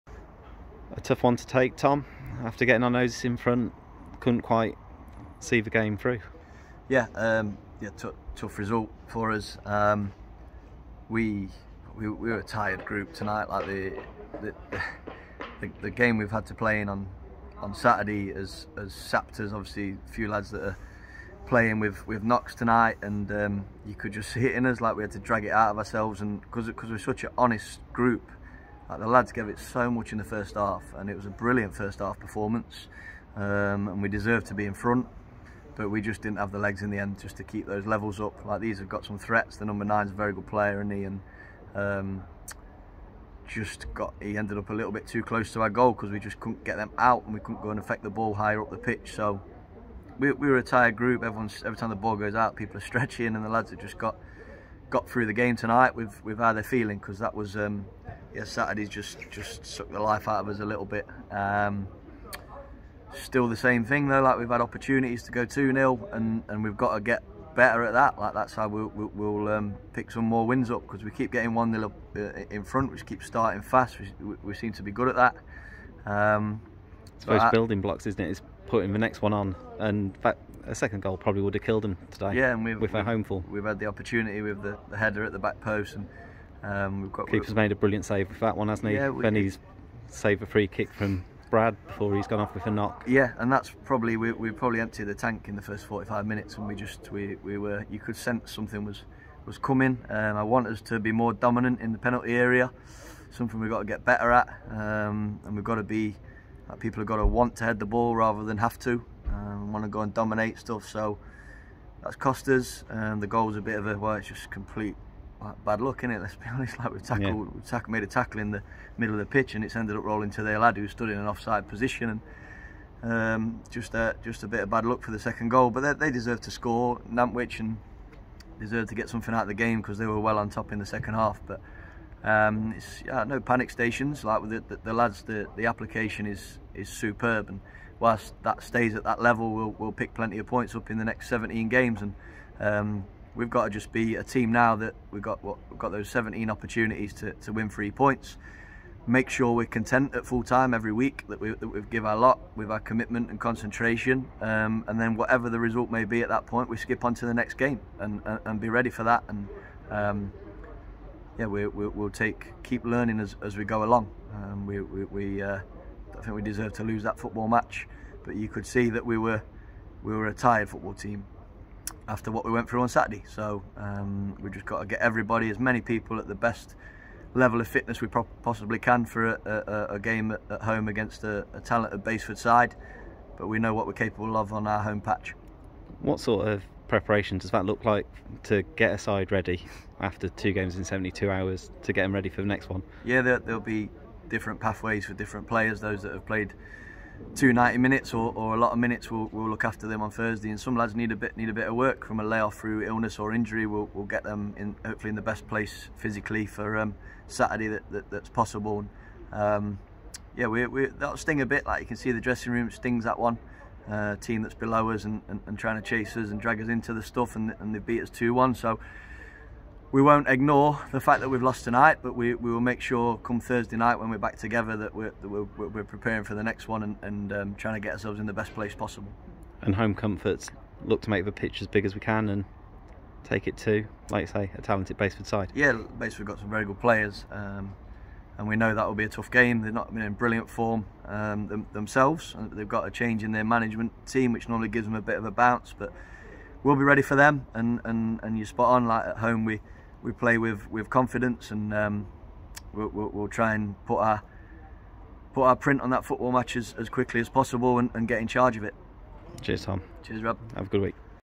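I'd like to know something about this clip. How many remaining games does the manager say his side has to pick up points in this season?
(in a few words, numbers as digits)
17.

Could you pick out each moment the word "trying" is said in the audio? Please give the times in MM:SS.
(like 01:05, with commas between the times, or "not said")
03:35, 03:47.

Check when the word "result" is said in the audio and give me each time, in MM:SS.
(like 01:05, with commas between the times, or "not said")
00:08, 02:35.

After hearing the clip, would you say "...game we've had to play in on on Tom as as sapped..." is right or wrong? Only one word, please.
wrong.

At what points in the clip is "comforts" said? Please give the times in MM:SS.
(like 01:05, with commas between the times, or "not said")
03:49.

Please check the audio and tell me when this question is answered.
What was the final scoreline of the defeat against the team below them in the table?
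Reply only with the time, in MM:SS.
03:38.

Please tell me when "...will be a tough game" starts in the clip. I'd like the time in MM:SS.
03:58.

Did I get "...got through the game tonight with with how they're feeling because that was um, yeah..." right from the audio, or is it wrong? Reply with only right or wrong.
right.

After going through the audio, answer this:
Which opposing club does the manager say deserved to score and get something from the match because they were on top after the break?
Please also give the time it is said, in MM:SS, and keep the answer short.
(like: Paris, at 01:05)
Nantwich, at 02:07.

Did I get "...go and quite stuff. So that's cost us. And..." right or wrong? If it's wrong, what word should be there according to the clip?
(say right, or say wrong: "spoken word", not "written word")
wrong: "dominate", not "quite".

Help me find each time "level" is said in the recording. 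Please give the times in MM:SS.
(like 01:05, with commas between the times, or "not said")
00:37, 02:19, 02:57.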